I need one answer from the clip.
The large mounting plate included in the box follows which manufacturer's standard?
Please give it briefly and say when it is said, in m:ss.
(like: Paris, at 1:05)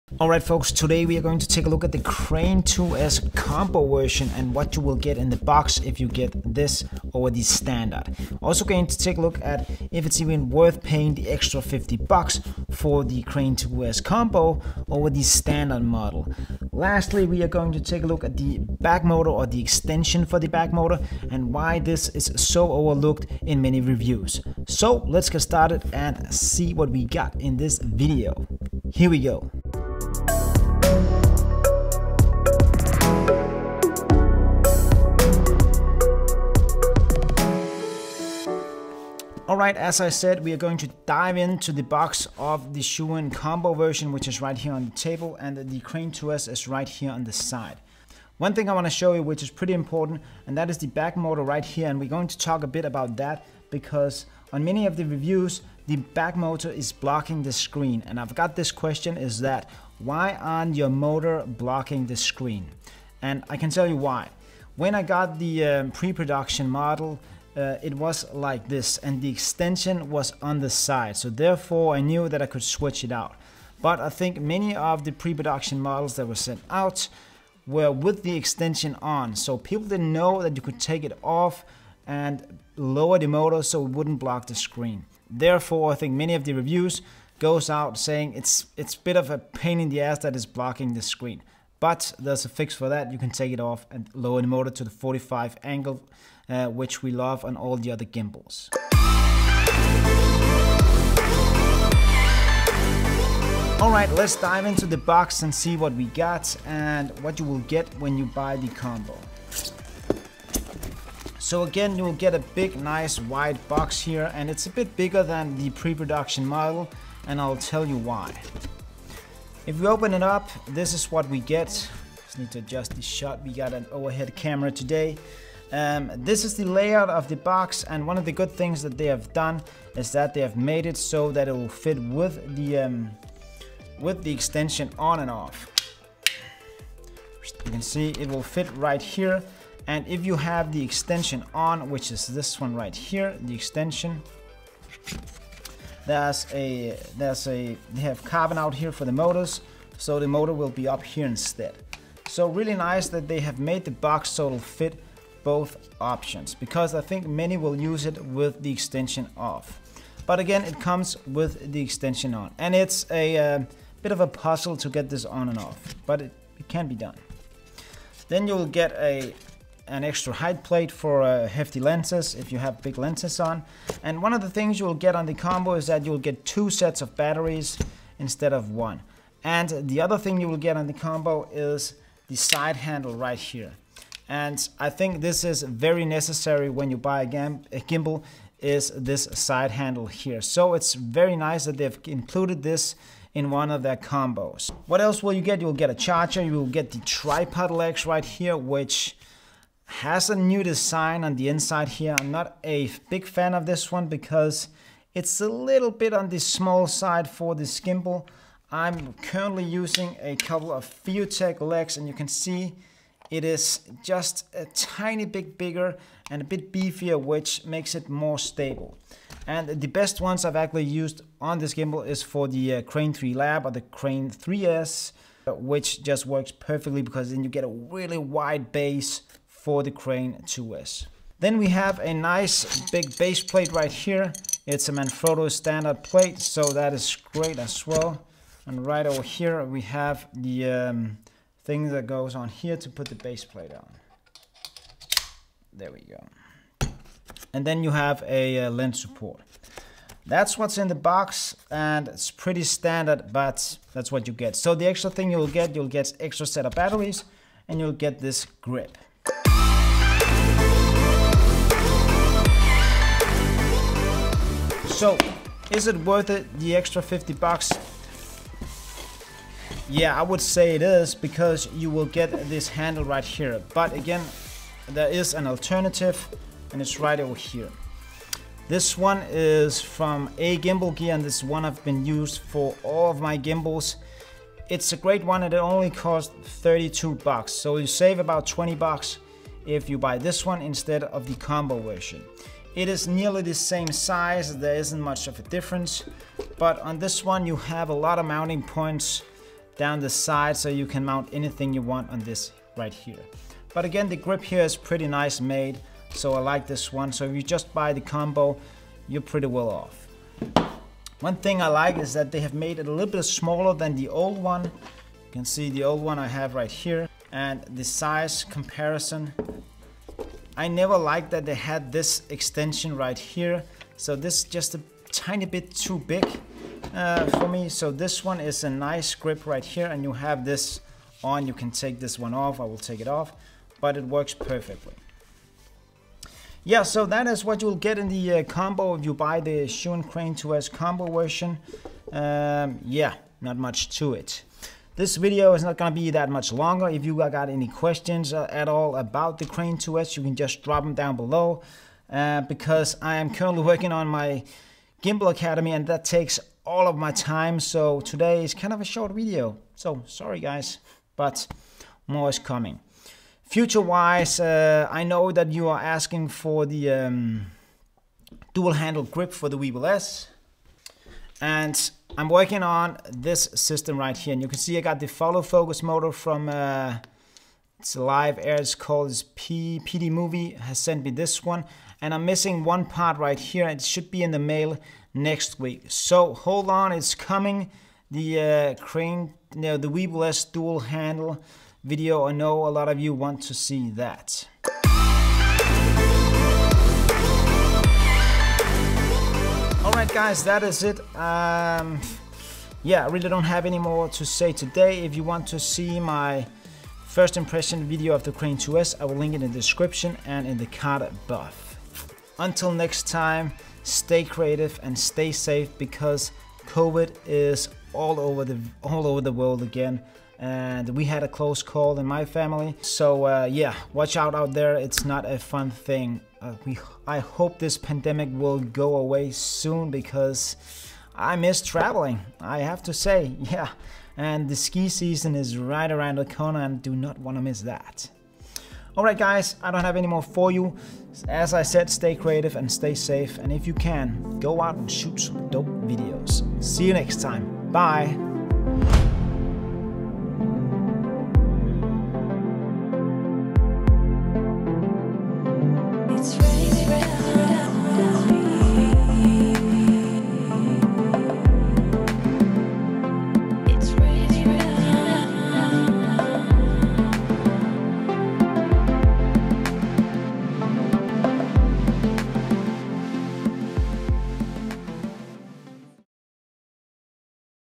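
Manfrotto, at 3:54.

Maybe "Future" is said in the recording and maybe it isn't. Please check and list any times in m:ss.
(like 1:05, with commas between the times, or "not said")
6:03.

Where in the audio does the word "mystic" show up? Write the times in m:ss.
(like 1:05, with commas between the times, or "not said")
not said.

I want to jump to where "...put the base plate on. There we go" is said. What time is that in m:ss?
4:02.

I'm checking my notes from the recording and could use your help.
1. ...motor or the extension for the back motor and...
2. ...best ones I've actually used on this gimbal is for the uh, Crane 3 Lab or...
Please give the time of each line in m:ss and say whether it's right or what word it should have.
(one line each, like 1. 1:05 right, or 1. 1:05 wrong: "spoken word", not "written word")
1. 0:19 right
2. 3:39 right.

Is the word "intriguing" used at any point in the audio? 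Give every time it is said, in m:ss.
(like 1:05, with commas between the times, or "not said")
not said.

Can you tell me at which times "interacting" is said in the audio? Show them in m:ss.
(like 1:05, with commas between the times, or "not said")
not said.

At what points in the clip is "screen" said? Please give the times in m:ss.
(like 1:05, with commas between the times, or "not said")
0:57, 1:02, 1:24, 1:31.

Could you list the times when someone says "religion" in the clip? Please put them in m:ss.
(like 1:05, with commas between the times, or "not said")
not said.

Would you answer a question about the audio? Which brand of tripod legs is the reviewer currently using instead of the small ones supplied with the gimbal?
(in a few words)
FeoTech.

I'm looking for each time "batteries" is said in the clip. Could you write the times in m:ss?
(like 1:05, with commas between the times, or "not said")
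2:57, 4:16.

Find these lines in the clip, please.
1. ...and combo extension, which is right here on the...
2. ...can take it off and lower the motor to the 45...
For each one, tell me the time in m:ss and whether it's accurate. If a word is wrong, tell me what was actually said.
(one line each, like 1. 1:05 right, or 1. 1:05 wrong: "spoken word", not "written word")
1. 0:43 wrong: "version", not "extension"
2. 1:33 right.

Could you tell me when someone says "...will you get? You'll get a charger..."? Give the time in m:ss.
3:15.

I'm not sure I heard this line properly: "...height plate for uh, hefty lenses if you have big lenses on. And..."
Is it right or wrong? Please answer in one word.
right.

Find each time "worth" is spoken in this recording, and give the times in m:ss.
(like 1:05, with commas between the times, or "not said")
0:10, 4:26.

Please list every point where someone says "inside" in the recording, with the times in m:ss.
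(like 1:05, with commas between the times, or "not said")
3:21.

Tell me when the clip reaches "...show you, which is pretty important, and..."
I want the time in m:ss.
0:48.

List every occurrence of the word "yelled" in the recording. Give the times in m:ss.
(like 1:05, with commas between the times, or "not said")
not said.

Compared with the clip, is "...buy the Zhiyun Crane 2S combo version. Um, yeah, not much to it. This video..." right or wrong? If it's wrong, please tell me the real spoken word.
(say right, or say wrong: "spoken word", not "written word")
right.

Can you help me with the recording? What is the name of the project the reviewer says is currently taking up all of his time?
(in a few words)
Gimbal Academy.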